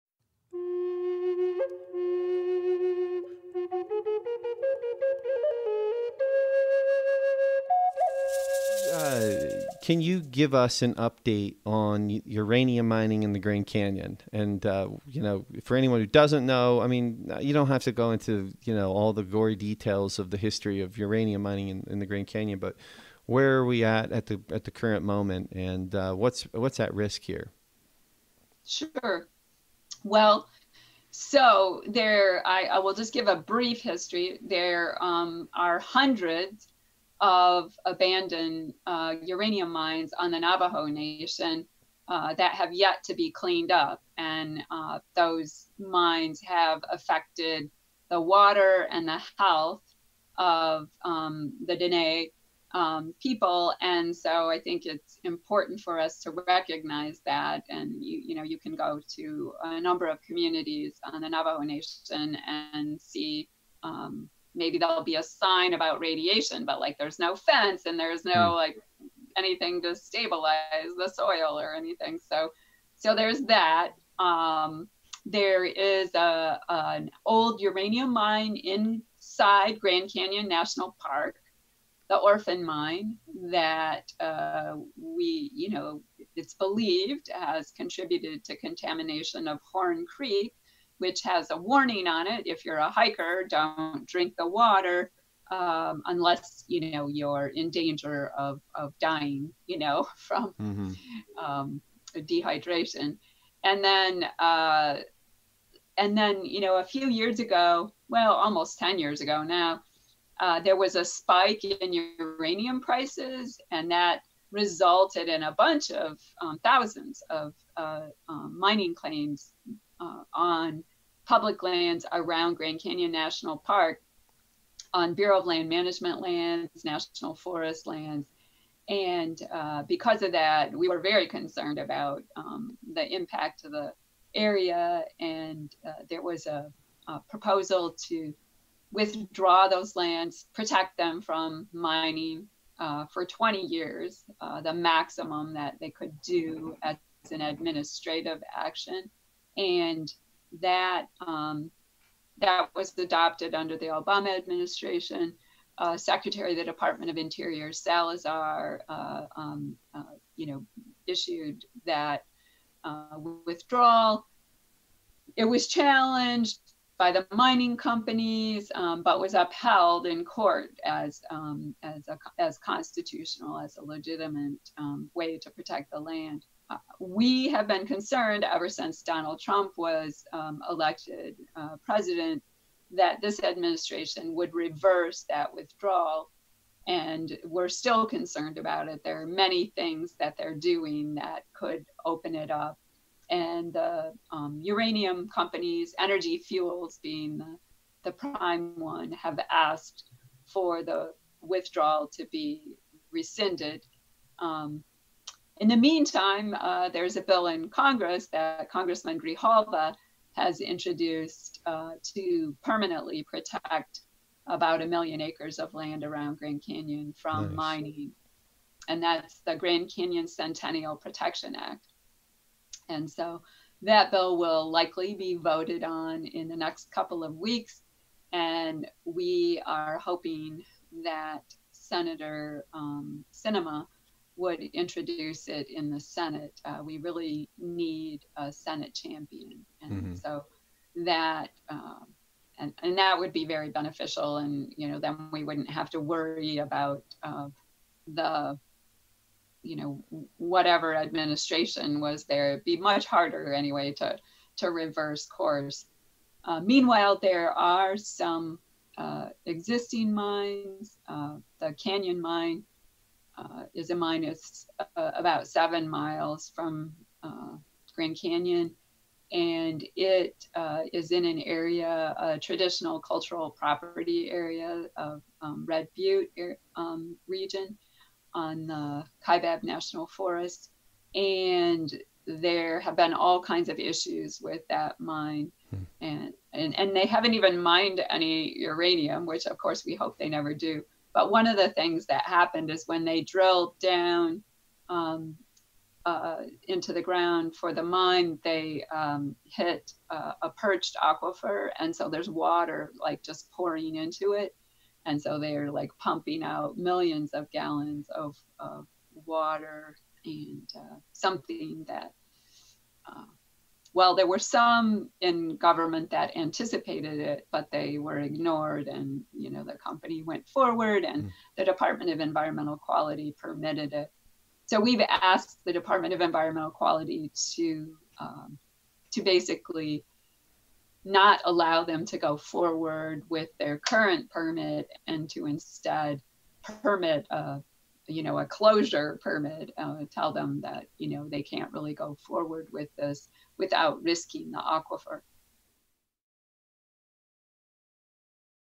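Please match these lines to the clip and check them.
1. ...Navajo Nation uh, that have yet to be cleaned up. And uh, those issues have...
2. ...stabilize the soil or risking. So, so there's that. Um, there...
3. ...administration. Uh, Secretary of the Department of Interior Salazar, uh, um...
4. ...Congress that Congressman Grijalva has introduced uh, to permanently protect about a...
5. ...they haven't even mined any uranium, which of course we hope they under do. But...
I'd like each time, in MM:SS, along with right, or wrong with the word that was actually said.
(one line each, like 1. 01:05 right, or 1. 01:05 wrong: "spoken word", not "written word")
1. 00:40 wrong: "mines", not "issues"
2. 01:09 wrong: "anything", not "risking"
3. 02:34 right
4. 03:27 right
5. 04:46 wrong: "never", not "under".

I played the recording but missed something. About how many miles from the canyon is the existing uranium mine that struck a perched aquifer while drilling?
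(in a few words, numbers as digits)
7.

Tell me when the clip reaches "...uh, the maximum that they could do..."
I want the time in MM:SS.
02:24.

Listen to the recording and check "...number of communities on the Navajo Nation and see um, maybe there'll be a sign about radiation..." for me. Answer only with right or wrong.
right.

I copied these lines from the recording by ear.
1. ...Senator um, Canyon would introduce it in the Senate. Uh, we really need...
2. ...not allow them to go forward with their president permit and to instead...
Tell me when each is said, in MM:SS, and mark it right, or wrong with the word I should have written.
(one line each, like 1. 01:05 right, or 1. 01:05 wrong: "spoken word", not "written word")
1. 03:51 wrong: "Sinema", not "Canyon"
2. 05:31 wrong: "current", not "president".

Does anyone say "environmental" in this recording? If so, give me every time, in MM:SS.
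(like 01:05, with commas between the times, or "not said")
05:22, 05:26.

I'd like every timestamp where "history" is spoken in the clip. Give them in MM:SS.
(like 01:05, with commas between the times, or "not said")
00:20, 00:33.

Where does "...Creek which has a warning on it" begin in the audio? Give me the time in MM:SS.
01:30.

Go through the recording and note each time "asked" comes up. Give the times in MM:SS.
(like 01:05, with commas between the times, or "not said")
03:19, 05:25.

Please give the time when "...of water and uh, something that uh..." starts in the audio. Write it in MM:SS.
05:08.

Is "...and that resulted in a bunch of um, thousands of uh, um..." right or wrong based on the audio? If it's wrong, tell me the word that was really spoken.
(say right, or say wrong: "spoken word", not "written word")
right.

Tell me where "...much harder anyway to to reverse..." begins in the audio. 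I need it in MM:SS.
04:12.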